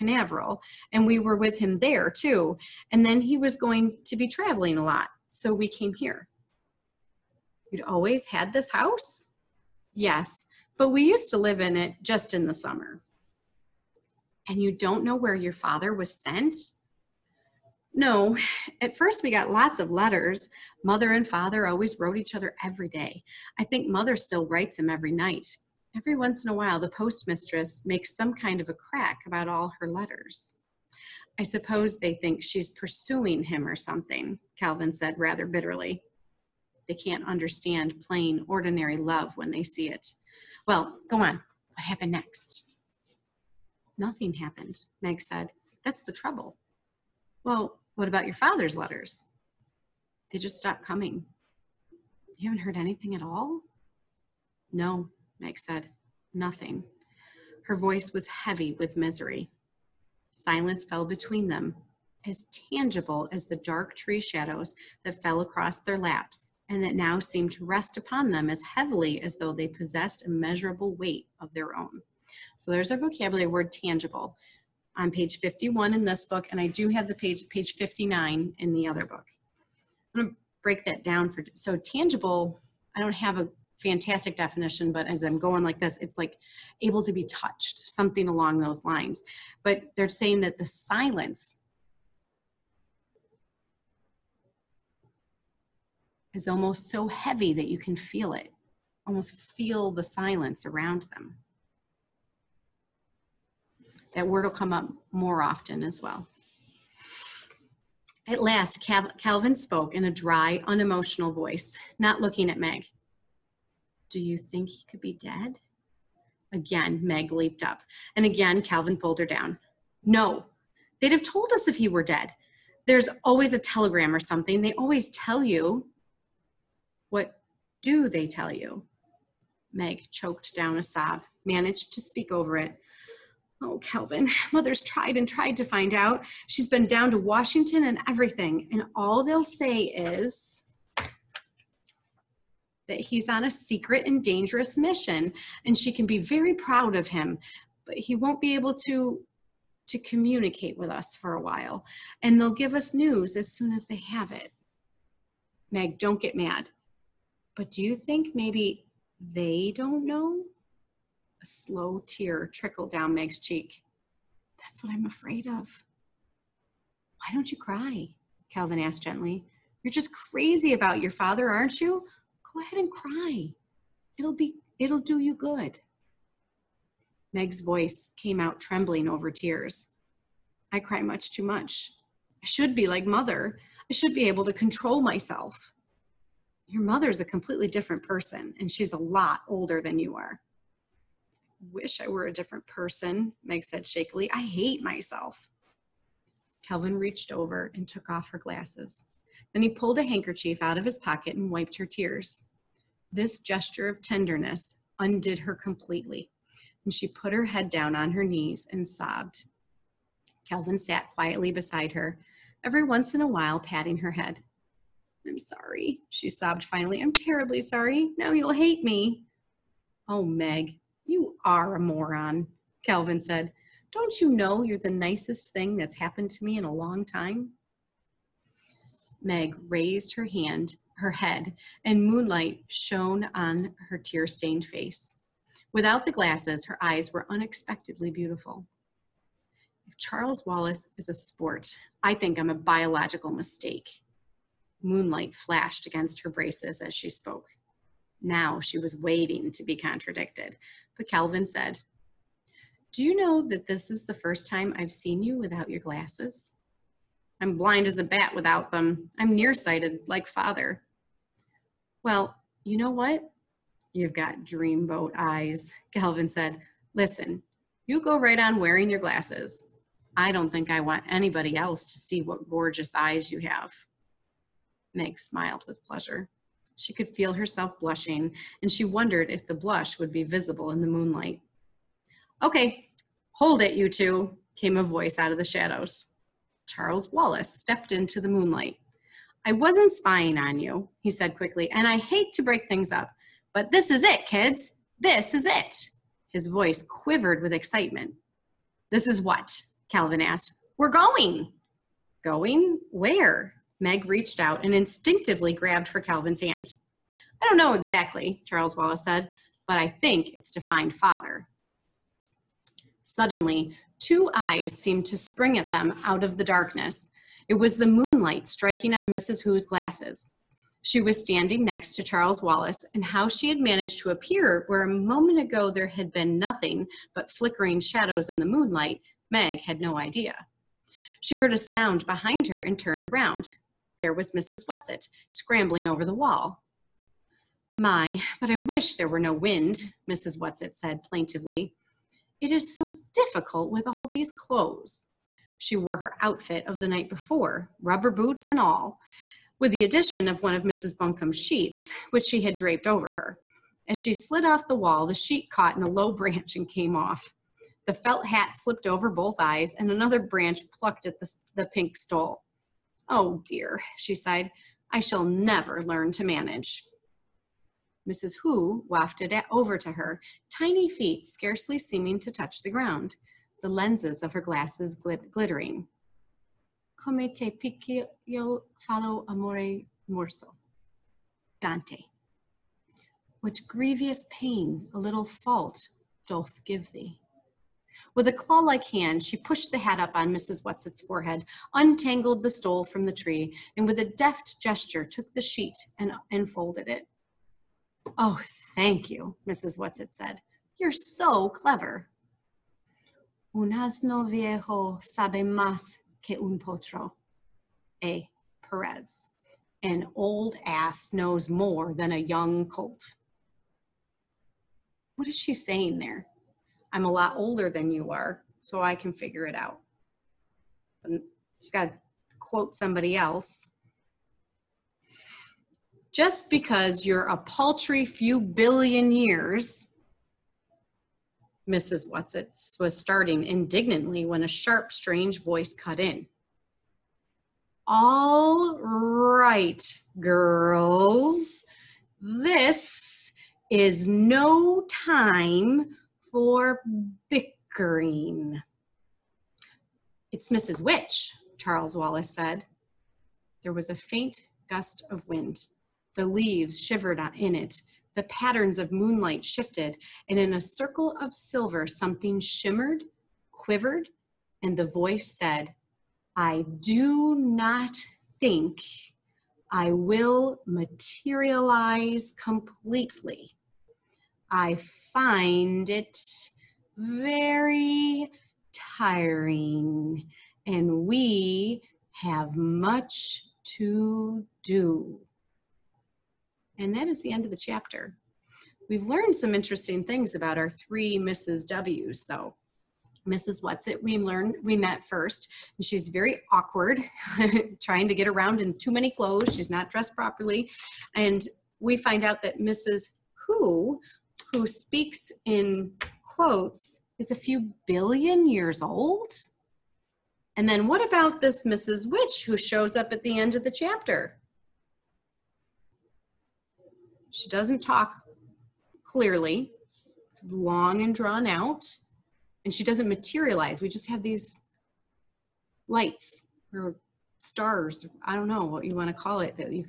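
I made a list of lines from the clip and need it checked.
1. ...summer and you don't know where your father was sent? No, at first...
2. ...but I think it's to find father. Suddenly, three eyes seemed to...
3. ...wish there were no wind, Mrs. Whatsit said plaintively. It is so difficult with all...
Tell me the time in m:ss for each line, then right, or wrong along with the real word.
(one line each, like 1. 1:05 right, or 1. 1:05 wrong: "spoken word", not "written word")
1. 0:12 right
2. 5:09 wrong: "two", not "three"
3. 5:38 right.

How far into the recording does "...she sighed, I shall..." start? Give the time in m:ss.
6:03.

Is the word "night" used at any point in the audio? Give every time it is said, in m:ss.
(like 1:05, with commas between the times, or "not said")
0:25, 5:46.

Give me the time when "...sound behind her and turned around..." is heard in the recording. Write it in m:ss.
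5:31.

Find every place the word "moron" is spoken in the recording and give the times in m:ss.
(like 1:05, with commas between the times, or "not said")
3:41.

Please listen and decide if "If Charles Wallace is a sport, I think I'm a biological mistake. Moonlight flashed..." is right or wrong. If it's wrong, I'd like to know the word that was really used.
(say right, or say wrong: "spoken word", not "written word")
right.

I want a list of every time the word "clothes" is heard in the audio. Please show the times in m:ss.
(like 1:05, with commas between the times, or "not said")
5:44, 8:19.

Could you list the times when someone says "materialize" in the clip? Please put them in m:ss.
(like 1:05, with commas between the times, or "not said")
7:50, 8:43.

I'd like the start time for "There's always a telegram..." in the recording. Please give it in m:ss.
2:02.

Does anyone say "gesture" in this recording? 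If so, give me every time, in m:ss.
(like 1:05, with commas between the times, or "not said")
3:23, 6:34.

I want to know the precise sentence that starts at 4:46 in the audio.
Charles Wallace stepped into the moonlight.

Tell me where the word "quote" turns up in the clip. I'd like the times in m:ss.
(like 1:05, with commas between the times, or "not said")
7:02, 8:26.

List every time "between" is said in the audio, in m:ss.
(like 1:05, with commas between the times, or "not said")
1:01.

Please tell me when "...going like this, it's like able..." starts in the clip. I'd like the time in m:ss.
1:25.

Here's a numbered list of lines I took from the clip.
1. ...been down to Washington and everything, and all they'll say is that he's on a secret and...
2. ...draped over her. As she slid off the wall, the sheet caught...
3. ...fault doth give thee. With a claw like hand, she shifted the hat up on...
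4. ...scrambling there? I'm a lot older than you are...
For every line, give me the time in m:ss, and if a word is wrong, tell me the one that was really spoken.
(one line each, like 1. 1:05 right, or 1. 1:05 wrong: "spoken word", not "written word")
1. 2:16 right
2. 5:52 right
3. 6:25 wrong: "pushed", not "shifted"
4. 6:55 wrong: "saying", not "scrambling".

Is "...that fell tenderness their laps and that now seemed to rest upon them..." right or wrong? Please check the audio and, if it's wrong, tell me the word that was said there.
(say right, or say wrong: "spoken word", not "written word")
wrong: "across", not "tenderness".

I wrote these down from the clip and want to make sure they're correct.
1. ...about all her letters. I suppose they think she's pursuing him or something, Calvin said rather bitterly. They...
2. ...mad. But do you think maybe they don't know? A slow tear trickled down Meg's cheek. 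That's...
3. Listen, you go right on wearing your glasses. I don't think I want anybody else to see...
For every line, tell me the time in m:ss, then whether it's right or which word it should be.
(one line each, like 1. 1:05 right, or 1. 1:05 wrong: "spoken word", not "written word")
1. 0:29 right
2. 2:36 right
3. 4:26 right.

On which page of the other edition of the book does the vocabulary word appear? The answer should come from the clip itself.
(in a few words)
Page 59.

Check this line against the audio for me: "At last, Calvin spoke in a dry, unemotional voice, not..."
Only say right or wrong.
right.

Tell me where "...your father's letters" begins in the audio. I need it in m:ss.
0:48.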